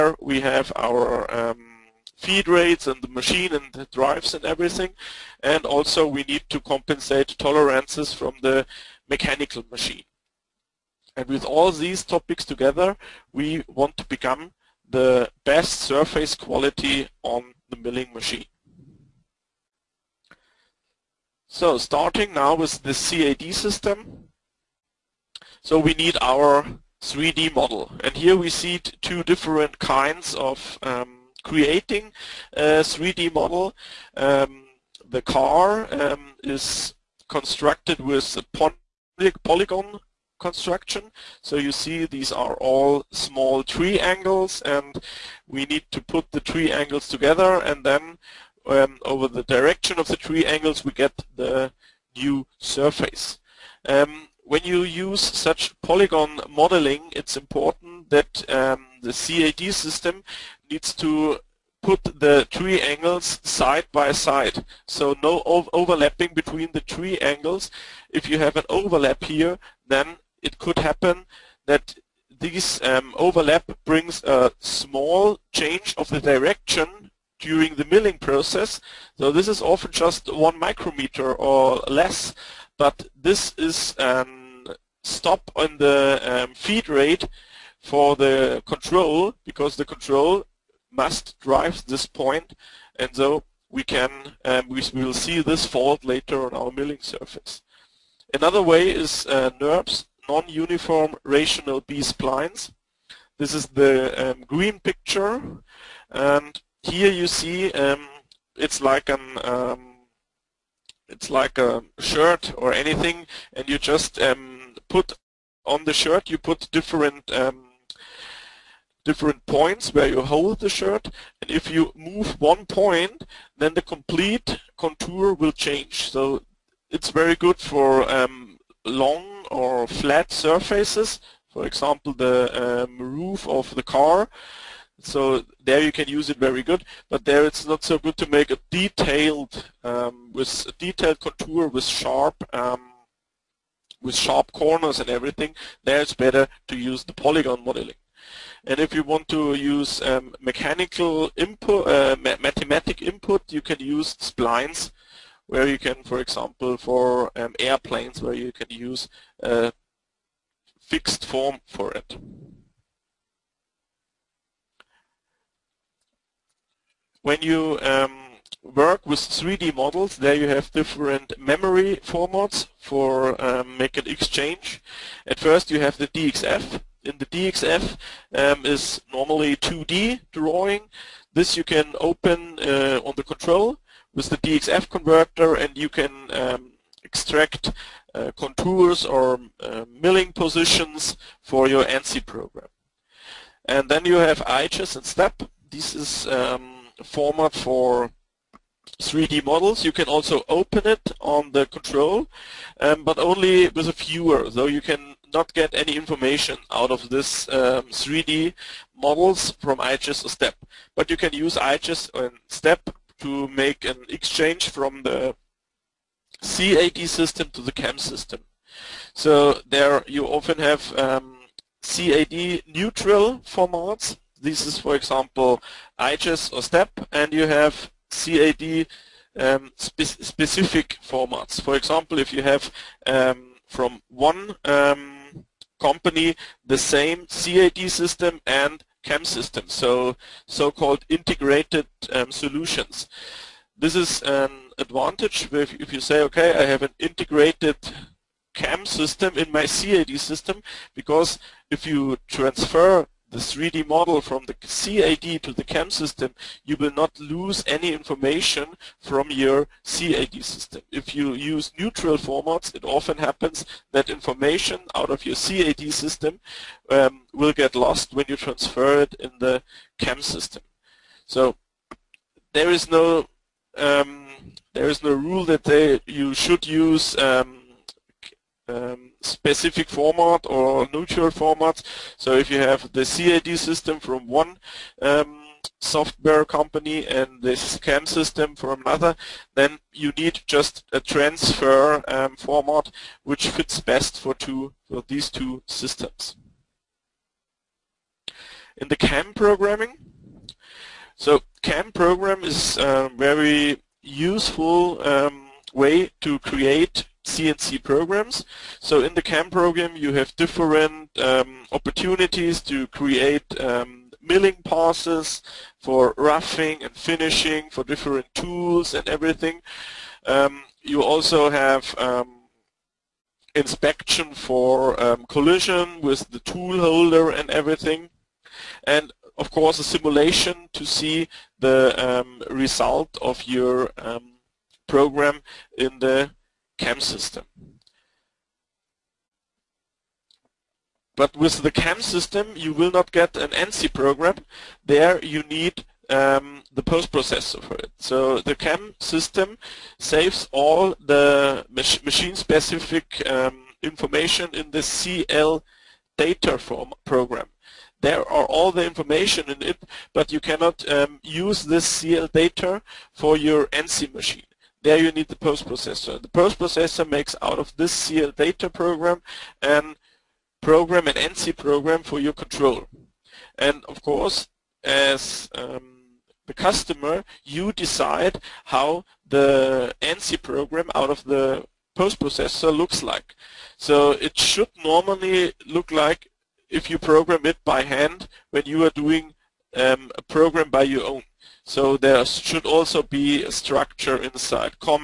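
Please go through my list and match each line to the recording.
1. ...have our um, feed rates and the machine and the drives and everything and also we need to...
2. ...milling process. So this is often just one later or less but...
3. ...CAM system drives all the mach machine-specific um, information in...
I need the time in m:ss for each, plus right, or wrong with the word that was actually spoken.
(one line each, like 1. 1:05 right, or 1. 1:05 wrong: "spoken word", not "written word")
1. 0:00 right
2. 1:17 wrong: "micrometer", not "later"
3. 5:48 wrong: "saves", not "drives".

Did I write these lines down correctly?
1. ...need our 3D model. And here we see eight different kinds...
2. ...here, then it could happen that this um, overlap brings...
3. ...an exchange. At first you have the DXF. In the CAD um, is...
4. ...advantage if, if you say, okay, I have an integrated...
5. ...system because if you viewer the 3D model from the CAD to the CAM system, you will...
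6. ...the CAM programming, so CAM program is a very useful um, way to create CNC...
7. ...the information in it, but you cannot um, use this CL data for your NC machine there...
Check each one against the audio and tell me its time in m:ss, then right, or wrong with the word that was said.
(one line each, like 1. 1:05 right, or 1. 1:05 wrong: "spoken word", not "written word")
1. 0:25 wrong: "two", not "eight"
2. 1:09 right
3. 2:53 wrong: "DXF", not "CAD"
4. 4:04 right
5. 4:10 wrong: "transfer", not "viewer"
6. 4:58 right
7. 5:58 right.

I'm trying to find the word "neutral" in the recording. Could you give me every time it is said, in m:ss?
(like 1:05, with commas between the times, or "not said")
3:42, 4:21, 4:40.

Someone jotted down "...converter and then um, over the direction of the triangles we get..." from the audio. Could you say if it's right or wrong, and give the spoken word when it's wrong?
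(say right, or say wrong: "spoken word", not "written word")
wrong: "together", not "converter".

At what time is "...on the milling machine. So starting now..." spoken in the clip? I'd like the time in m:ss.
0:17.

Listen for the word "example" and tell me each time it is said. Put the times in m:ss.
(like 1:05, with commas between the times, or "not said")
2:11, 2:36, 3:44, 3:51.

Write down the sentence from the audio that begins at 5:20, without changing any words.
Um, you also have um, inspection for um, collision with the tool holder and everything.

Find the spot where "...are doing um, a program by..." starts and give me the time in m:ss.
6:28.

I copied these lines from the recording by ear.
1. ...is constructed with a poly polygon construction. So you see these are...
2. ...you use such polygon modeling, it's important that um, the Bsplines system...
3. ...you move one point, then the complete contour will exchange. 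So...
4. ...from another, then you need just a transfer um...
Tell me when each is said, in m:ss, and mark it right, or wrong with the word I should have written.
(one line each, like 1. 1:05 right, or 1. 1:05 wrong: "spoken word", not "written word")
1. 0:36 right
2. 0:54 wrong: "CAD", not "Bsplines"
3. 2:01 wrong: "change", not "exchange"
4. 4:48 right.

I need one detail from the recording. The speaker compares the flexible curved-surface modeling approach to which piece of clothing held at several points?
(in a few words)
A shirt.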